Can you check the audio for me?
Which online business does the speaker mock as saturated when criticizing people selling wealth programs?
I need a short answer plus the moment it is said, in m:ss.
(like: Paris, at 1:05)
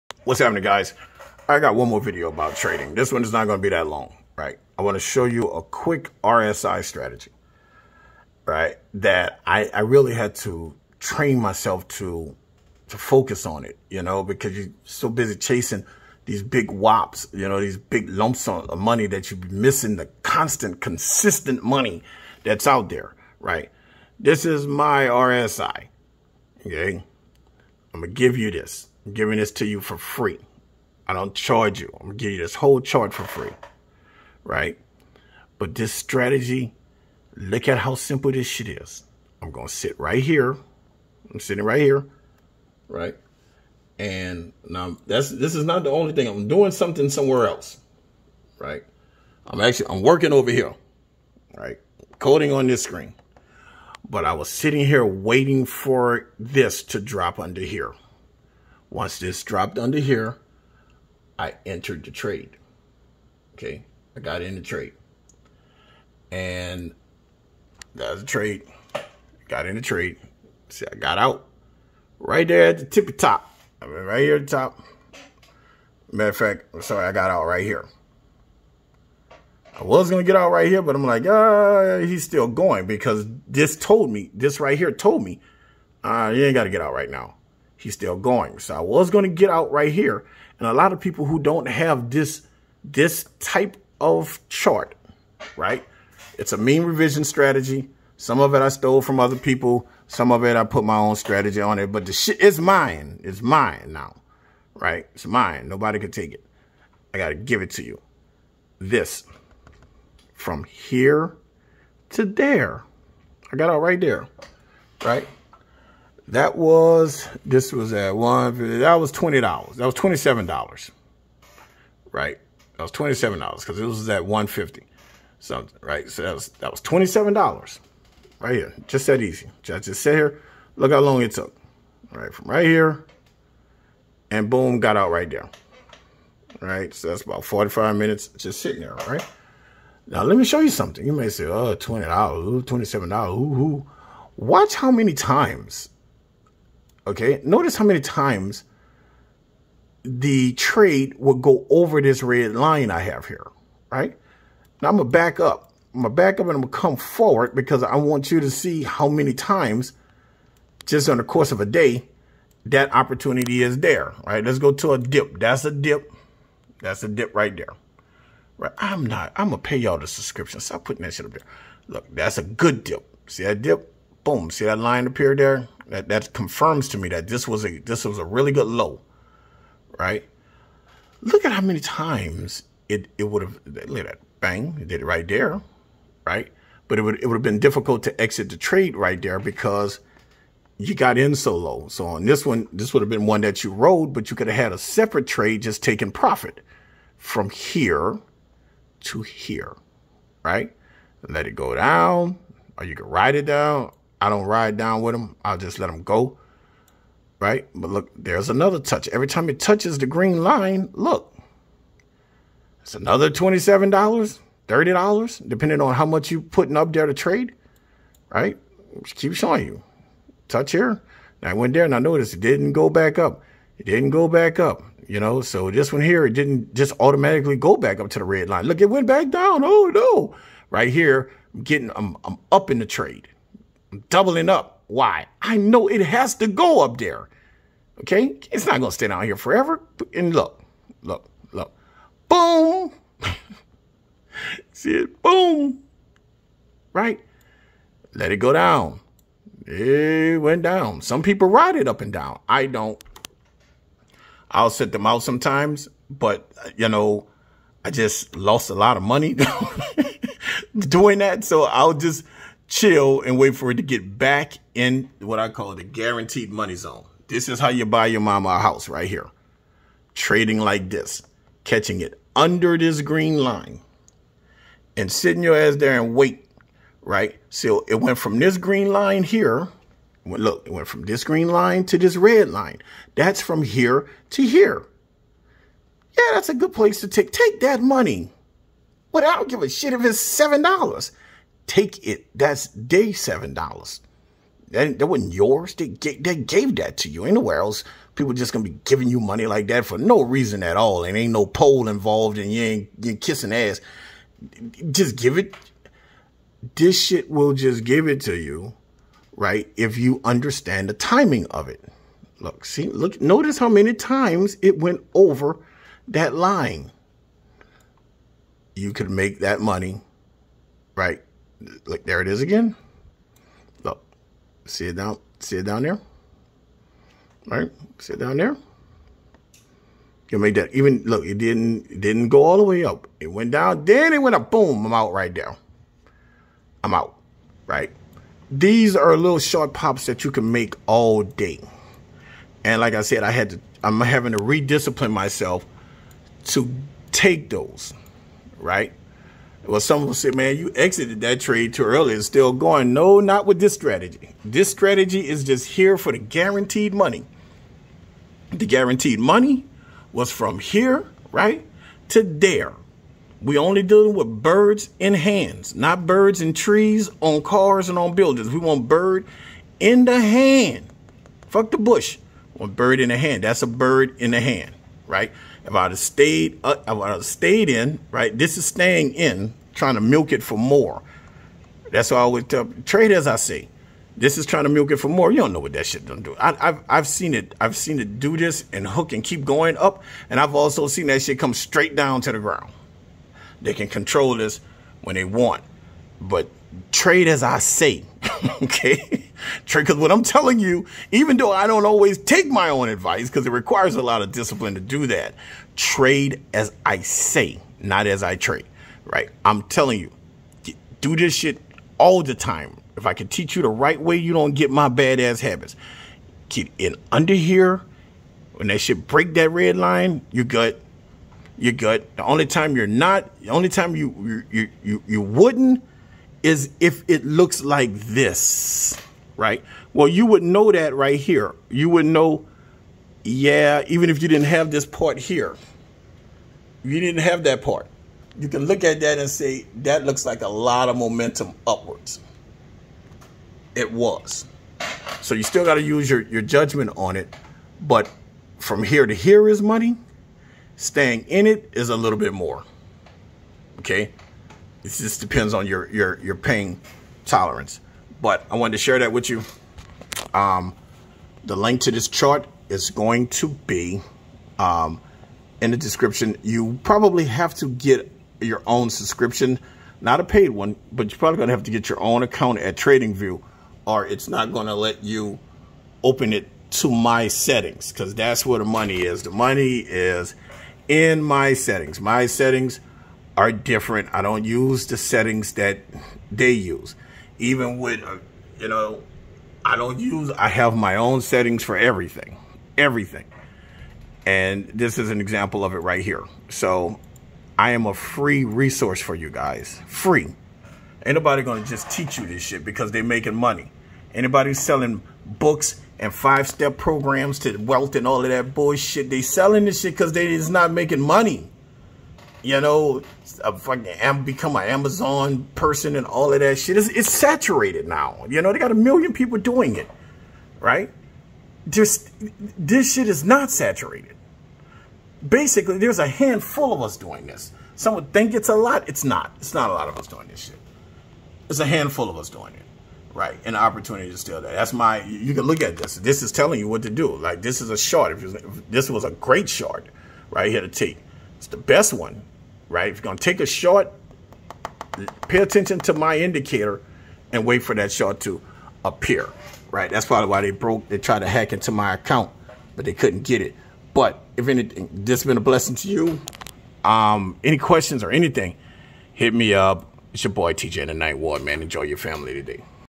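Amazon, at 8:34.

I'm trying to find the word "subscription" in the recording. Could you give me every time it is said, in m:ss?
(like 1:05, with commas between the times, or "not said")
2:50, 7:48.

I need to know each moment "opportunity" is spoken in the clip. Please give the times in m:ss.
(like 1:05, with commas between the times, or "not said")
2:42, 8:53.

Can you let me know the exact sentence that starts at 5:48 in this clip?
Right well, someone said, man, you exited that trade too early.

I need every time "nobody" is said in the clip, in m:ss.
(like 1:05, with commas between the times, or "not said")
1:45, 8:21.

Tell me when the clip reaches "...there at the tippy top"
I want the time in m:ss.
1:12.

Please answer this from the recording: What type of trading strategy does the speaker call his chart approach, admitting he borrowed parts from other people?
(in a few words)
mean reversion strategy.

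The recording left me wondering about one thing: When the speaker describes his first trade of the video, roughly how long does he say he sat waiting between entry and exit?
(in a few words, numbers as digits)
45 minutes.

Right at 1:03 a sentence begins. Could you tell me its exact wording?
Okay, I got in the trade.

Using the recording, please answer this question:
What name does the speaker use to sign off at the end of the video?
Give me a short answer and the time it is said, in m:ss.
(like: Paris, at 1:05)
TJ the Night Ward, at 9:20.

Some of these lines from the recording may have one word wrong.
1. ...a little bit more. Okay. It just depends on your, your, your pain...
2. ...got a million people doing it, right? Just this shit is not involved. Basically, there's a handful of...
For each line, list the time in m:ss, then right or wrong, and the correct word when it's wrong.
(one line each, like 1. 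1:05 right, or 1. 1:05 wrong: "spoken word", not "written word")
1. 7:31 right
2. 8:38 wrong: "saturated", not "involved".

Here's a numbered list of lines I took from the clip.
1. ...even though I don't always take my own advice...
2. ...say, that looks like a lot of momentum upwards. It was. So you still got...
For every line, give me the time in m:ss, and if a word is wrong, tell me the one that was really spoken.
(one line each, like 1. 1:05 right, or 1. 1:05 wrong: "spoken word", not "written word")
1. 6:41 right
2. 7:19 right.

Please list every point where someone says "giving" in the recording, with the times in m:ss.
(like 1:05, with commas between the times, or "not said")
0:29, 4:58.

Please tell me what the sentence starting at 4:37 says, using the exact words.
So it went from this green line here.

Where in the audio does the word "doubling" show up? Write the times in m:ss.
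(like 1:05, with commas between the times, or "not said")
3:54.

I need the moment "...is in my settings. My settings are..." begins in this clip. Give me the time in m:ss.
7:59.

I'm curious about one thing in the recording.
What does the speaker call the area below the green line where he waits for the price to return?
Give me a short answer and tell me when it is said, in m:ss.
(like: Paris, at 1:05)
guaranteed money zone, at 4:25.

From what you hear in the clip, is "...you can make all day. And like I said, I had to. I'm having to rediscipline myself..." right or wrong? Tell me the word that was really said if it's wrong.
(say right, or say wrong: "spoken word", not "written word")
right.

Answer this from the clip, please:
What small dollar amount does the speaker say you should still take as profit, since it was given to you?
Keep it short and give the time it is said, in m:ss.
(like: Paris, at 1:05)
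$7, at 4:53.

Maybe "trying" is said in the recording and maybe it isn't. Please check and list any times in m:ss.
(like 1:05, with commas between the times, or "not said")
6:19, 6:24.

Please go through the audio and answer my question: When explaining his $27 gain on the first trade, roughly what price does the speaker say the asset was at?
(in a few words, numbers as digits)
150 something.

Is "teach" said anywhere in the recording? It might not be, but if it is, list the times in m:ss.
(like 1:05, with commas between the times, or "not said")
6:53, 8:21.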